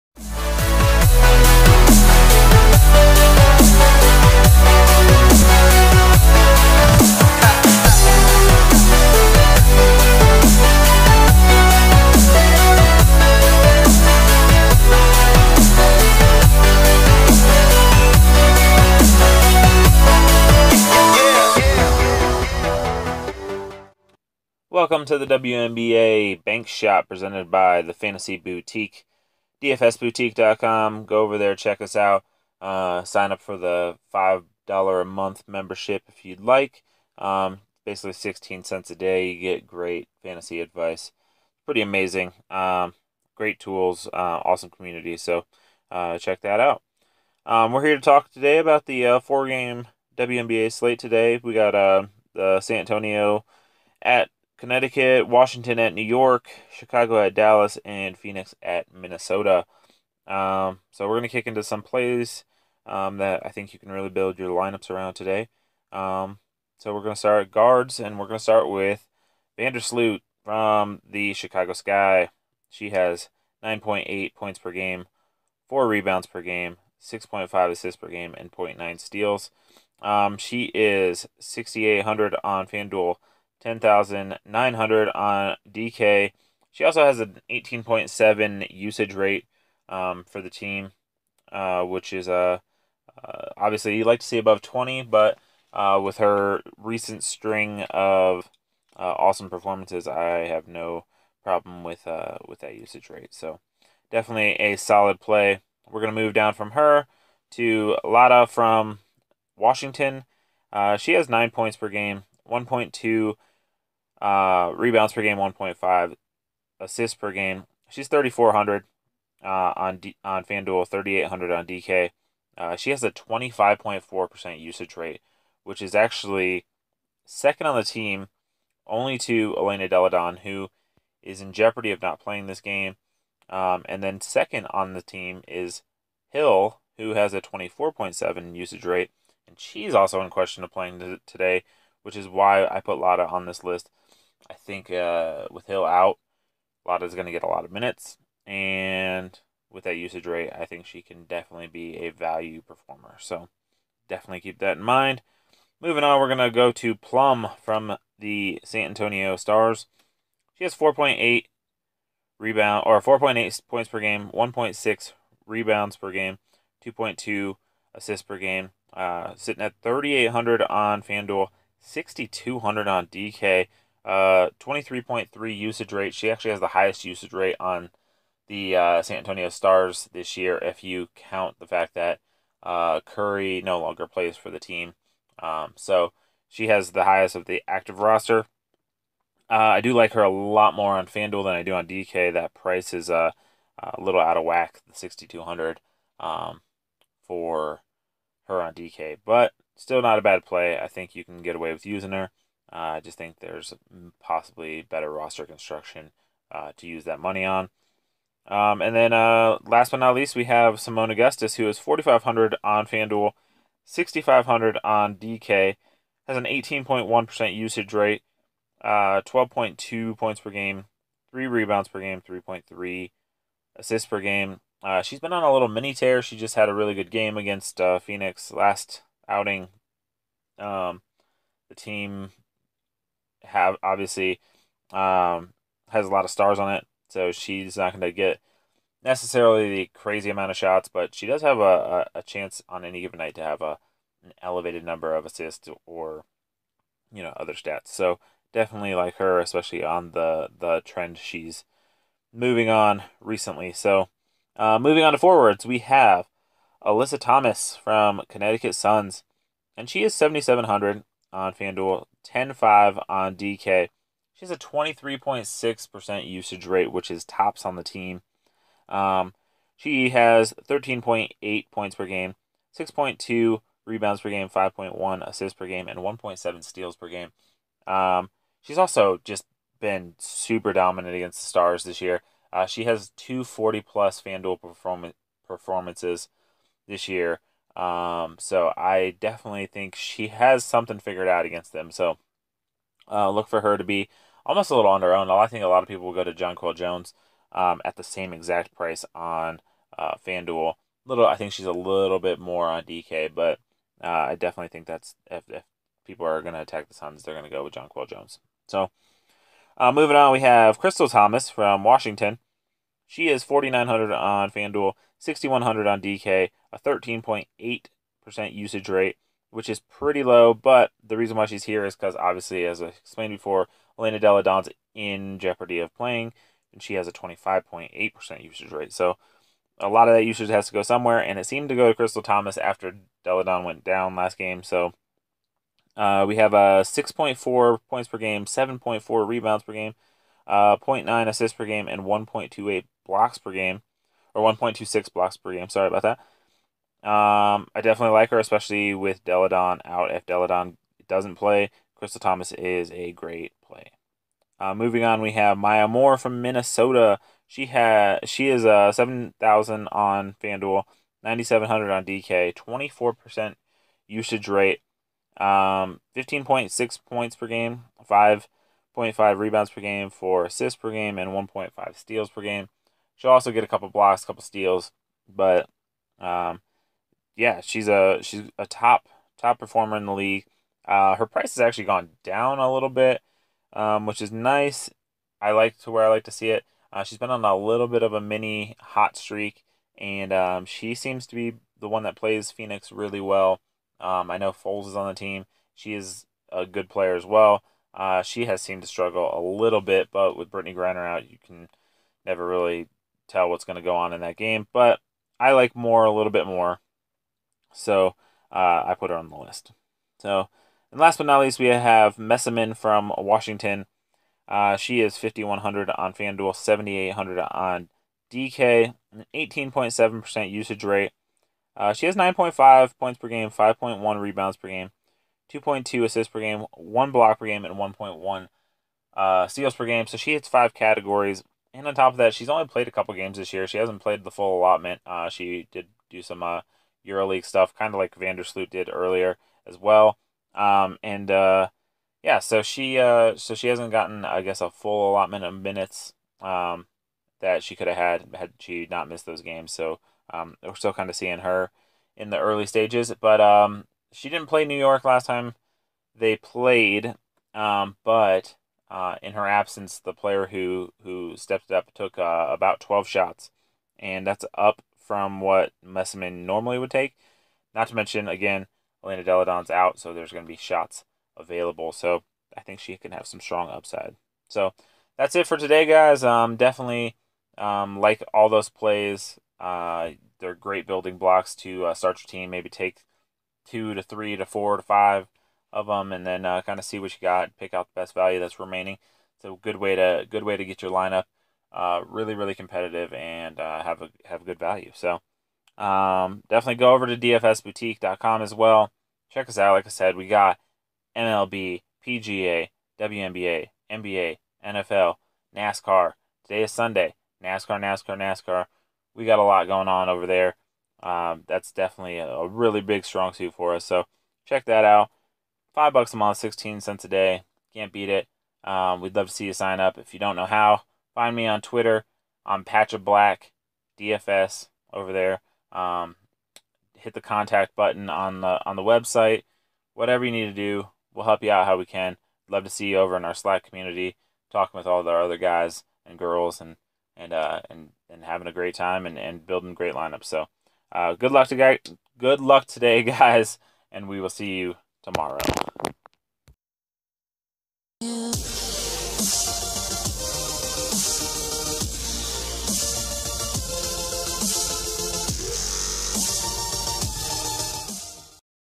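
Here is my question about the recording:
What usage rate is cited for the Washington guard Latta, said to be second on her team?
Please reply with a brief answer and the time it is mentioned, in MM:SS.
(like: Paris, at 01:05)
25.4%, at 02:03.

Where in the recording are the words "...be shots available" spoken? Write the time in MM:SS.
07:50.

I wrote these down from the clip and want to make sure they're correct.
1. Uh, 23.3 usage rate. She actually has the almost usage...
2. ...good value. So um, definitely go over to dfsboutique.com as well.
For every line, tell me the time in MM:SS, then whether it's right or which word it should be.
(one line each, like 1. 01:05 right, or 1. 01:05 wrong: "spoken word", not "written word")
1. 02:54 wrong: "highest", not "almost"
2. 08:14 right.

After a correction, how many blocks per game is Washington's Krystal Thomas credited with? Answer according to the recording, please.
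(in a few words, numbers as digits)
1.26.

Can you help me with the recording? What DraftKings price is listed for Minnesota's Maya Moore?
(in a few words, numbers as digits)
9,700.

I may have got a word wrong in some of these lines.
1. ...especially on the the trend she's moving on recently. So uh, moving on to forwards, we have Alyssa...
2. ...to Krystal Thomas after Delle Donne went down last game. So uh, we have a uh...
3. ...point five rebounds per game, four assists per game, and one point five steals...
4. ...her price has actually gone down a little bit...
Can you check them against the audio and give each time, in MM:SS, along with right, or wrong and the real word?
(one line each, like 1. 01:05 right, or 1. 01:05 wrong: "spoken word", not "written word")
1. 04:09 right
2. 05:31 right
3. 06:08 right
4. 06:21 right.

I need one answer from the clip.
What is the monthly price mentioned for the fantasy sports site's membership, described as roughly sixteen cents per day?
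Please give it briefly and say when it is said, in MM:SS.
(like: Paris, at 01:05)
$5, at 00:34.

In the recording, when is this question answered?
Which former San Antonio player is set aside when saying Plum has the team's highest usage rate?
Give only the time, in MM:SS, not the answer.
03:03.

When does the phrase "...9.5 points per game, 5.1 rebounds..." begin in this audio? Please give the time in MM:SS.
07:02.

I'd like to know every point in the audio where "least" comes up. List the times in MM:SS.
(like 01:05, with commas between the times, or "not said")
03:30, 06:51.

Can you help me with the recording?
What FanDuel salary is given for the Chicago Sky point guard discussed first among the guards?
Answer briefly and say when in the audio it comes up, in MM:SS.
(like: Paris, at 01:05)
6,800, at 01:21.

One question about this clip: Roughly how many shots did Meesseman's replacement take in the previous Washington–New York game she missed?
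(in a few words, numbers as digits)
12.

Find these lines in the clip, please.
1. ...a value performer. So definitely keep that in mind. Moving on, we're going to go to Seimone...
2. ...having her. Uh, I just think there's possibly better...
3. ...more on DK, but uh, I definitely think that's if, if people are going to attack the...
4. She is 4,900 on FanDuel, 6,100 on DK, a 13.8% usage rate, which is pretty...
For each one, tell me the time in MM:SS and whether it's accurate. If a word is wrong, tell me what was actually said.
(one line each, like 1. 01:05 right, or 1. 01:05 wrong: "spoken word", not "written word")
1. 02:31 wrong: "Plum", not "Seimone"
2. 03:21 wrong: "using", not "having"
3. 05:02 right
4. 05:13 right.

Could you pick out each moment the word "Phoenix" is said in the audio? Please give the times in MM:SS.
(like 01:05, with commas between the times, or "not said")
00:58, 03:47, 06:32.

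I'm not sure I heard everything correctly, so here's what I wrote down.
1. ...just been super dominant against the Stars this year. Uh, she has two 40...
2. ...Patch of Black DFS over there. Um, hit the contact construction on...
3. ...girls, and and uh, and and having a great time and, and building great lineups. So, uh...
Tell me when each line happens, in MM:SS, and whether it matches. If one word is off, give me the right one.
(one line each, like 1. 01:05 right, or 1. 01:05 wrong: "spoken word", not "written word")
1. 04:39 right
2. 08:42 wrong: "button", not "construction"
3. 08:56 right.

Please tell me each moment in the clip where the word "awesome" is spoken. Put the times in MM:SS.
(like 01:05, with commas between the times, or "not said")
00:44, 01:39.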